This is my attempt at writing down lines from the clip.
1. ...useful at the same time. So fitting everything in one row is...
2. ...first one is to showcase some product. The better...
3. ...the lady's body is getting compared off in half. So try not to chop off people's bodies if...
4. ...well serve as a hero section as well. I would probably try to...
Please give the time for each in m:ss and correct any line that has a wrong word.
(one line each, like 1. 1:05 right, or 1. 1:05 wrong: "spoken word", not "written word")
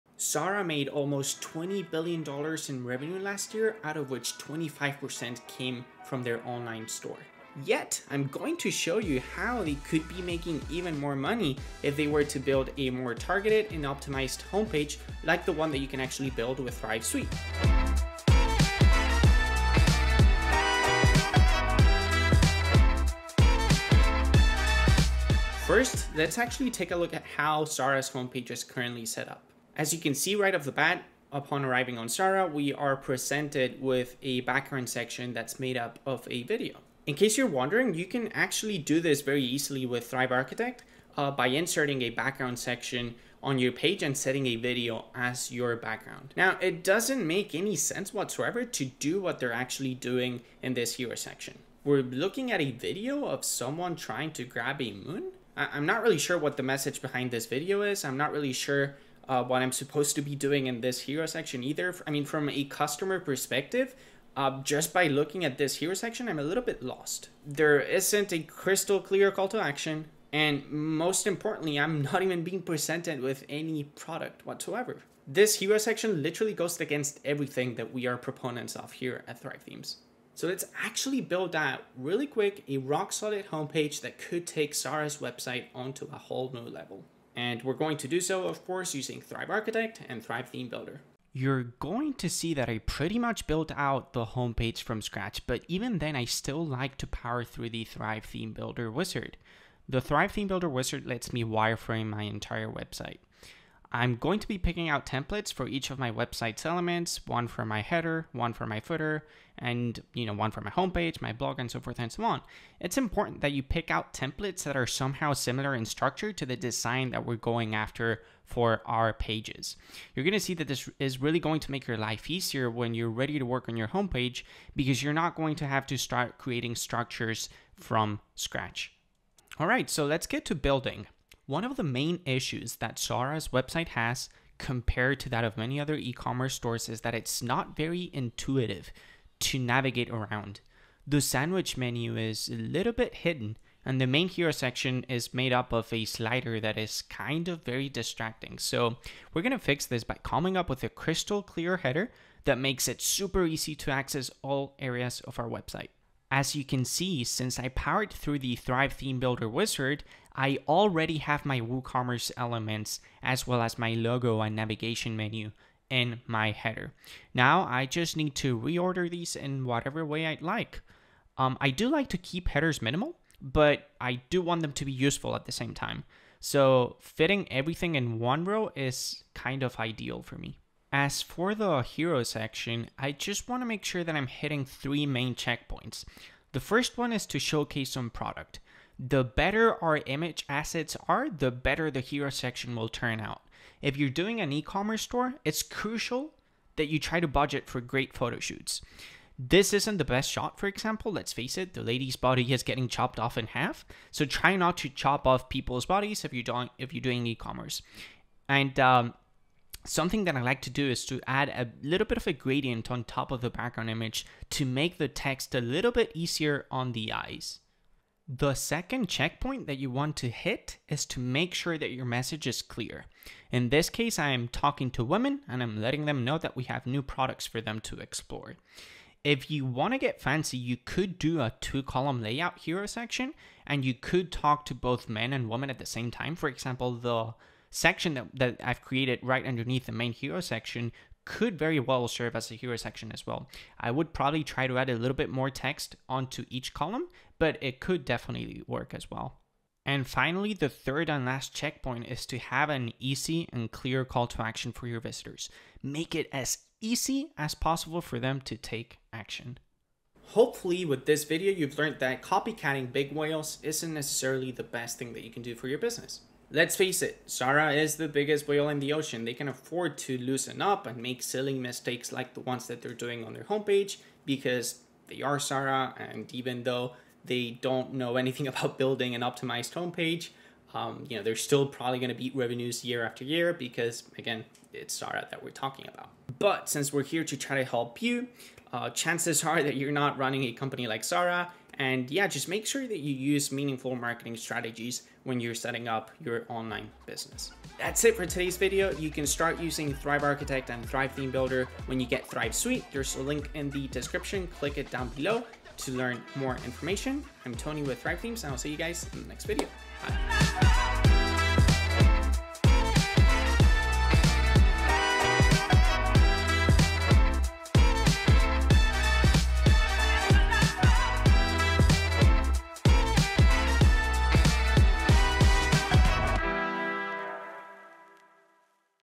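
1. 2:54 right
2. 3:06 right
3. 3:21 wrong: "chopped", not "compared"
4. 4:01 right.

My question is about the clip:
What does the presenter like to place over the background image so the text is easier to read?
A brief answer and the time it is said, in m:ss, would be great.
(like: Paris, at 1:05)
a gradient, at 3:32.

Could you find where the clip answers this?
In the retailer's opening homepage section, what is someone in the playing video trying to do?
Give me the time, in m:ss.
0:54.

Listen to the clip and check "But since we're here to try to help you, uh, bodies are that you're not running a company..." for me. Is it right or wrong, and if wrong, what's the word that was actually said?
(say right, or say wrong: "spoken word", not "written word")
wrong: "chances", not "bodies".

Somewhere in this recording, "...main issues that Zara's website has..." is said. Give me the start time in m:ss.
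2:11.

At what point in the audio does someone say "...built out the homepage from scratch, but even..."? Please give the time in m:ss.
1:33.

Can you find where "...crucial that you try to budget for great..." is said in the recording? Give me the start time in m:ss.
3:15.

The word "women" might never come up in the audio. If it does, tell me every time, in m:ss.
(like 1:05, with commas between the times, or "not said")
3:45, 3:55.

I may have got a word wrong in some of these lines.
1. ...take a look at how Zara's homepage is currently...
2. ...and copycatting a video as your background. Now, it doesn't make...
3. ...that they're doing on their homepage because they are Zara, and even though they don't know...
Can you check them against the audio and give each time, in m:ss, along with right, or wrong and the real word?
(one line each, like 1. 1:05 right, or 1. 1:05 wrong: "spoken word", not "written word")
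1. 0:26 right
2. 0:44 wrong: "setting", not "copycatting"
3. 4:32 right.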